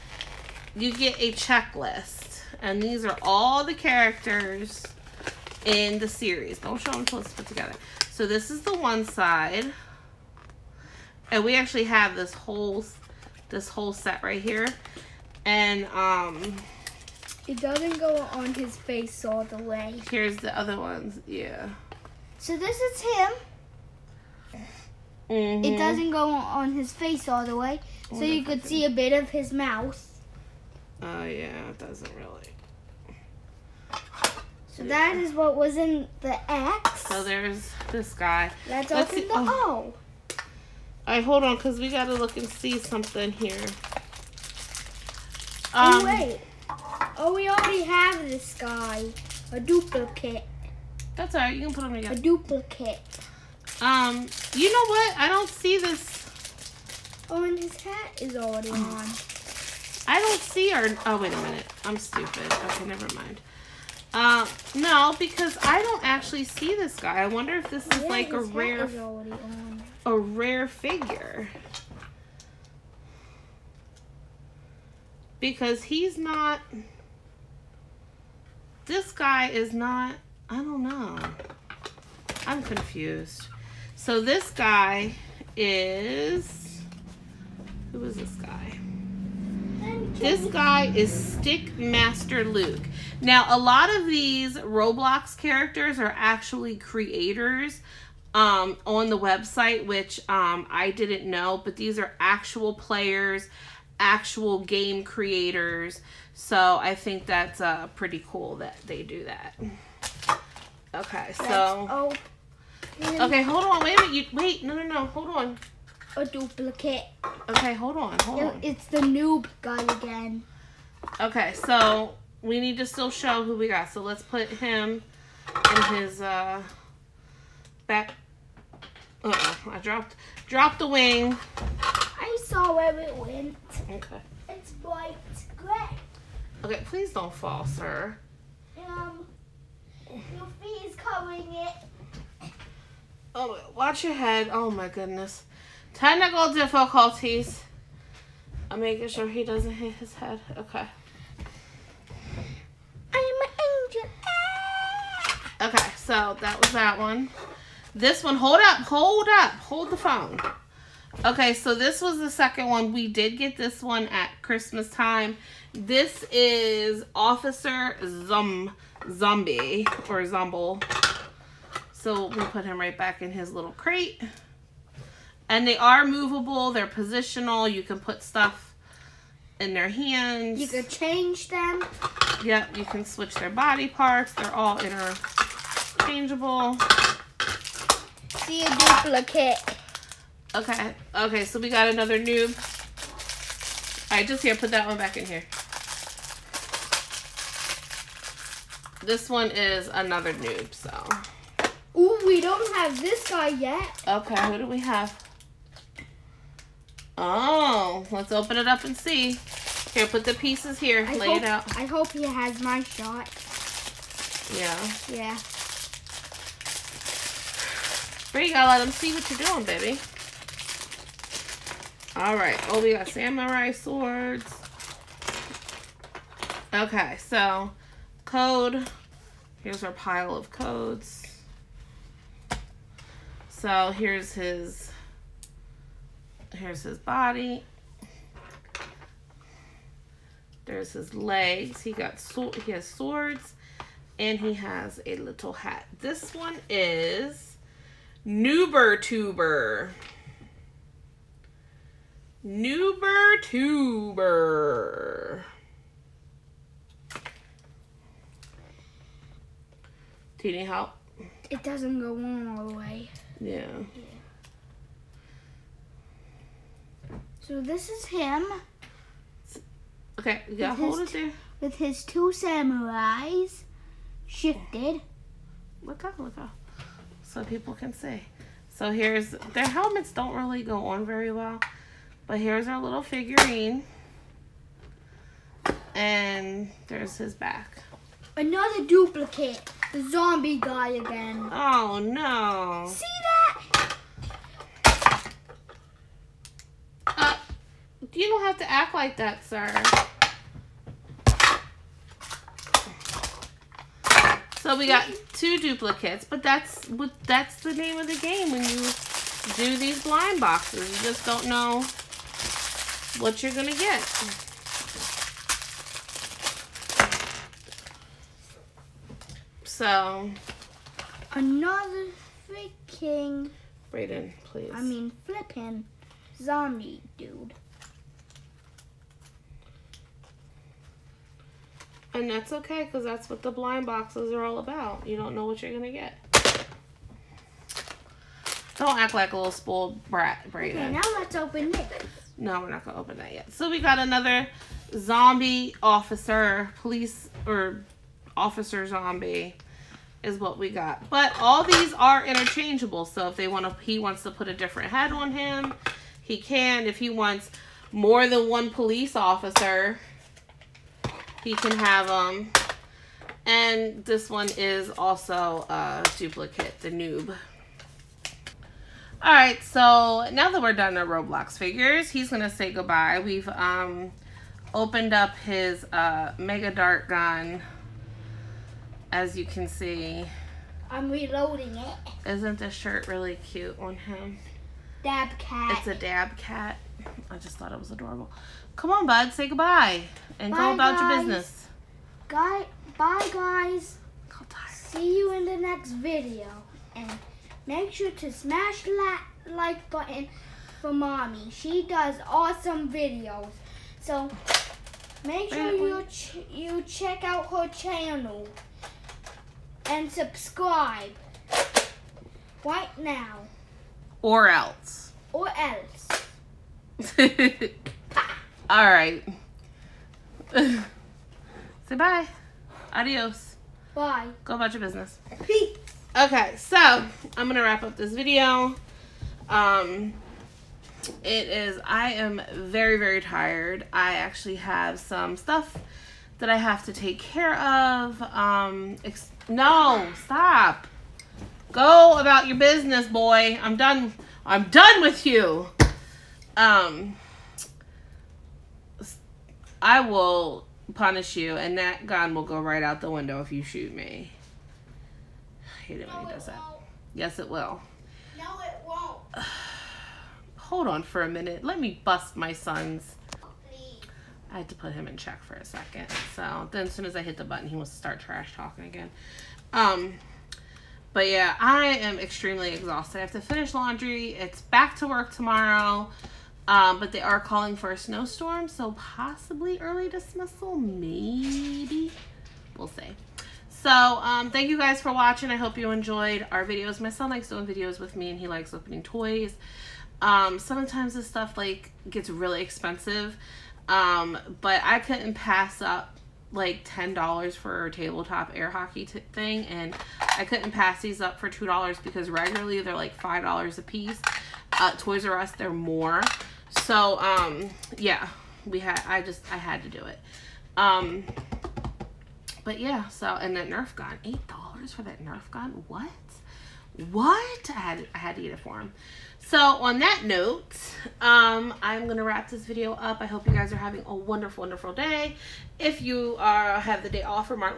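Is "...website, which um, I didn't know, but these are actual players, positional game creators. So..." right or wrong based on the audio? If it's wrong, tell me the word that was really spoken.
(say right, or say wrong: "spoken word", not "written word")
wrong: "actual", not "positional".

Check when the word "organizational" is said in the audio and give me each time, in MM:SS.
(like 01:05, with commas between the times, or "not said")
not said.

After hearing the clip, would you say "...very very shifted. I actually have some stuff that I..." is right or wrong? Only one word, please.
wrong.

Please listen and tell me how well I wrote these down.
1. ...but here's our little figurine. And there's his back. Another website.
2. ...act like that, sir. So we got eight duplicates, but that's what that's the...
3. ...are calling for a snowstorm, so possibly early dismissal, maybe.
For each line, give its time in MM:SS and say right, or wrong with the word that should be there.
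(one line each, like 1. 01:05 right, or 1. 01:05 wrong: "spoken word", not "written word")
1. 04:42 wrong: "duplicate", not "website"
2. 04:58 wrong: "two", not "eight"
3. 07:57 right.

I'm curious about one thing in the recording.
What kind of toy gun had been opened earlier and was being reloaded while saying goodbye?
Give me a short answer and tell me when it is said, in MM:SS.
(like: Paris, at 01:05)
Mega Dart gun, at 06:16.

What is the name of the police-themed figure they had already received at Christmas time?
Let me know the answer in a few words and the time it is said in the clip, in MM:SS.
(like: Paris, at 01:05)
Officer Zombie, at 02:47.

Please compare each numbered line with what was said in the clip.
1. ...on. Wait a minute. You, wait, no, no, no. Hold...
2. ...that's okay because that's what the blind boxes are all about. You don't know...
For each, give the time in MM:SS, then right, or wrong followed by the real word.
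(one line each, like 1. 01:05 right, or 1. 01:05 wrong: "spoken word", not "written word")
1. 01:53 right
2. 05:32 right.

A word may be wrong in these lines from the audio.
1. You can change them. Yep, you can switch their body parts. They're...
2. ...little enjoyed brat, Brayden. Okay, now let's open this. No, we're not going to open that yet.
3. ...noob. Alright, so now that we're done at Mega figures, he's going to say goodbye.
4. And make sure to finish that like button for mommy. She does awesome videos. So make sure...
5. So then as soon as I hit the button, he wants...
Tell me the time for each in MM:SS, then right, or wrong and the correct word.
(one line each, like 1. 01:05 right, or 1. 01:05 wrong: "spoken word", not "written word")
1. 03:00 right
2. 05:39 wrong: "spoiled", not "enjoyed"
3. 06:06 wrong: "Roblox", not "Mega"
4. 06:36 wrong: "smash", not "finish"
5. 07:46 right.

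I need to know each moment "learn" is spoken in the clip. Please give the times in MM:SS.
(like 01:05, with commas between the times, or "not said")
not said.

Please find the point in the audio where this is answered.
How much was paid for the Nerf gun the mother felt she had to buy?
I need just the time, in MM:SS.
08:34.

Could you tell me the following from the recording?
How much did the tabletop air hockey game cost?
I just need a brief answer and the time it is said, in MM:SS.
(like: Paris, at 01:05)
$10, at 08:16.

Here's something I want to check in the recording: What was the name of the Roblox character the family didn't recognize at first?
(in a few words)
Stick Master Luke.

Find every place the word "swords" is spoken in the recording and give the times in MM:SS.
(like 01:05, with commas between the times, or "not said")
03:43, 04:02.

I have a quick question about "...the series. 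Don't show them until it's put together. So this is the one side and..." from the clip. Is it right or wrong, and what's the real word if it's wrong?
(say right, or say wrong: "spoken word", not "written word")
right.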